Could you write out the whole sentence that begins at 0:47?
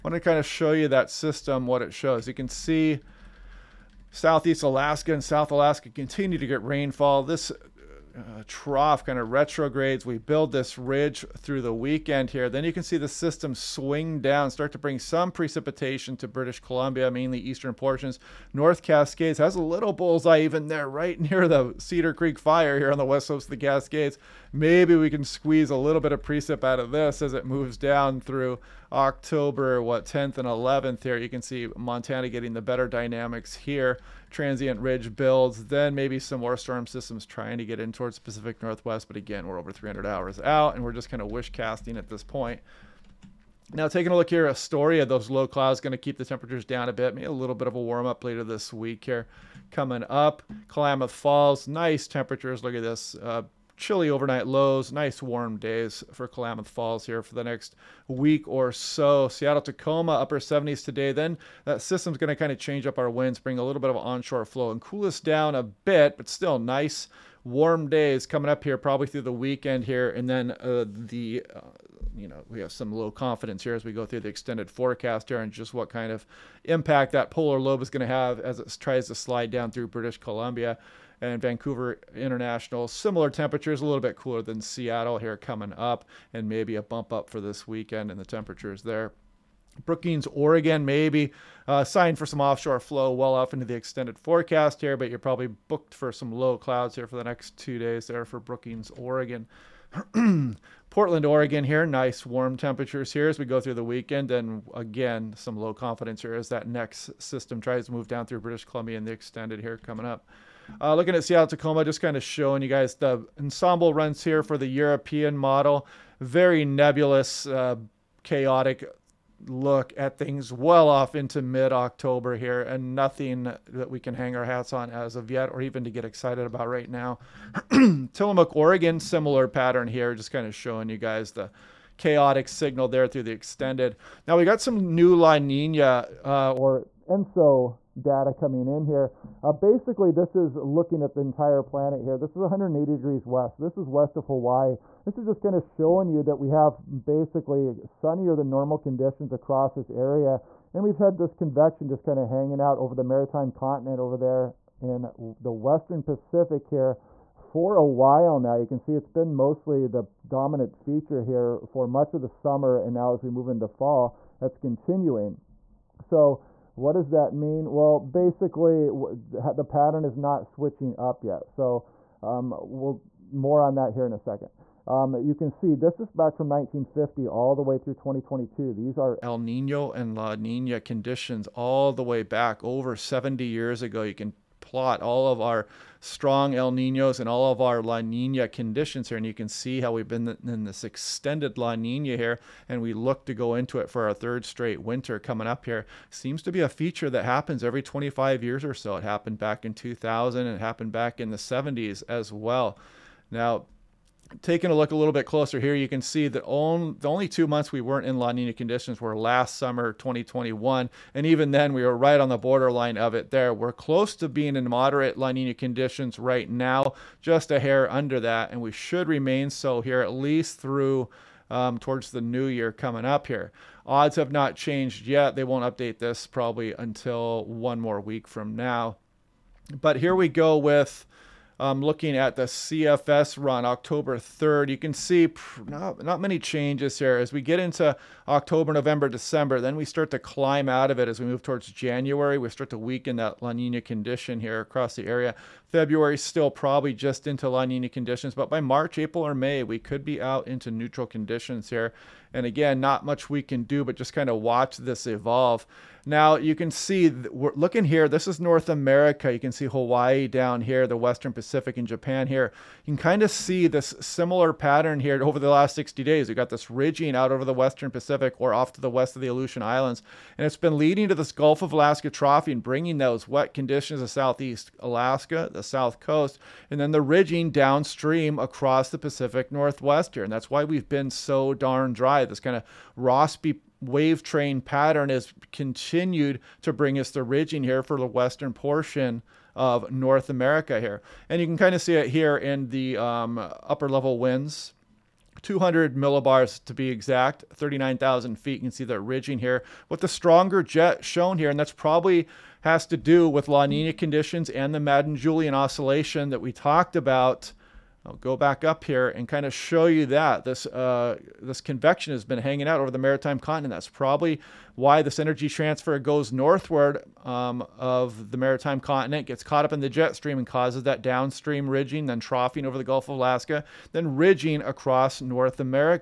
Maybe a little bit of a warm up later this week here coming up.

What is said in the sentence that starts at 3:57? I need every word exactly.
As we get into October, November, December, then we start to climb out of it as we move towards January.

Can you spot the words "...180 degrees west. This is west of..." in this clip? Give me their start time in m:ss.
2:22.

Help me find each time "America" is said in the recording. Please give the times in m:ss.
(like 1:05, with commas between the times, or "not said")
4:18, 4:50.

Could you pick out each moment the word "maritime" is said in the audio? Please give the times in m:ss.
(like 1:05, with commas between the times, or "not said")
2:33, 5:12, 5:18.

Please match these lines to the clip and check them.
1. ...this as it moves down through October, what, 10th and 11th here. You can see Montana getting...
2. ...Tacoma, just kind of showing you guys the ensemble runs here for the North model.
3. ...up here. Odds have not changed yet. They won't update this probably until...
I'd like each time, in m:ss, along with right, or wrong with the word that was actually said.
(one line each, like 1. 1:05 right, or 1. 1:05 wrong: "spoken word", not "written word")
1. 0:26 right
2. 1:51 wrong: "European", not "North"
3. 3:43 right.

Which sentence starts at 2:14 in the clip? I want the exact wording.
Now we got some new La Nina uh, or ENSO data coming in here.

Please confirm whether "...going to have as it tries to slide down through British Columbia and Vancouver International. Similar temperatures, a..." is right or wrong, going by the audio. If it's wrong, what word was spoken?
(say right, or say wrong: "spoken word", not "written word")
right.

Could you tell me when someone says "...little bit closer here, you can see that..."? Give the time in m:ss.
3:24.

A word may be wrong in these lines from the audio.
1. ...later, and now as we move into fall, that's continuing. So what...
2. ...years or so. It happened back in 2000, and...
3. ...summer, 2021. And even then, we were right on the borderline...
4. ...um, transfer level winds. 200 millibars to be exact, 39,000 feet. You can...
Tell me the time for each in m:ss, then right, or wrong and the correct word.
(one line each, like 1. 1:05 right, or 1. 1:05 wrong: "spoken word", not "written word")
1. 2:42 wrong: "summer", not "later"
2. 3:18 right
3. 3:29 right
4. 4:52 wrong: "upper", not "transfer".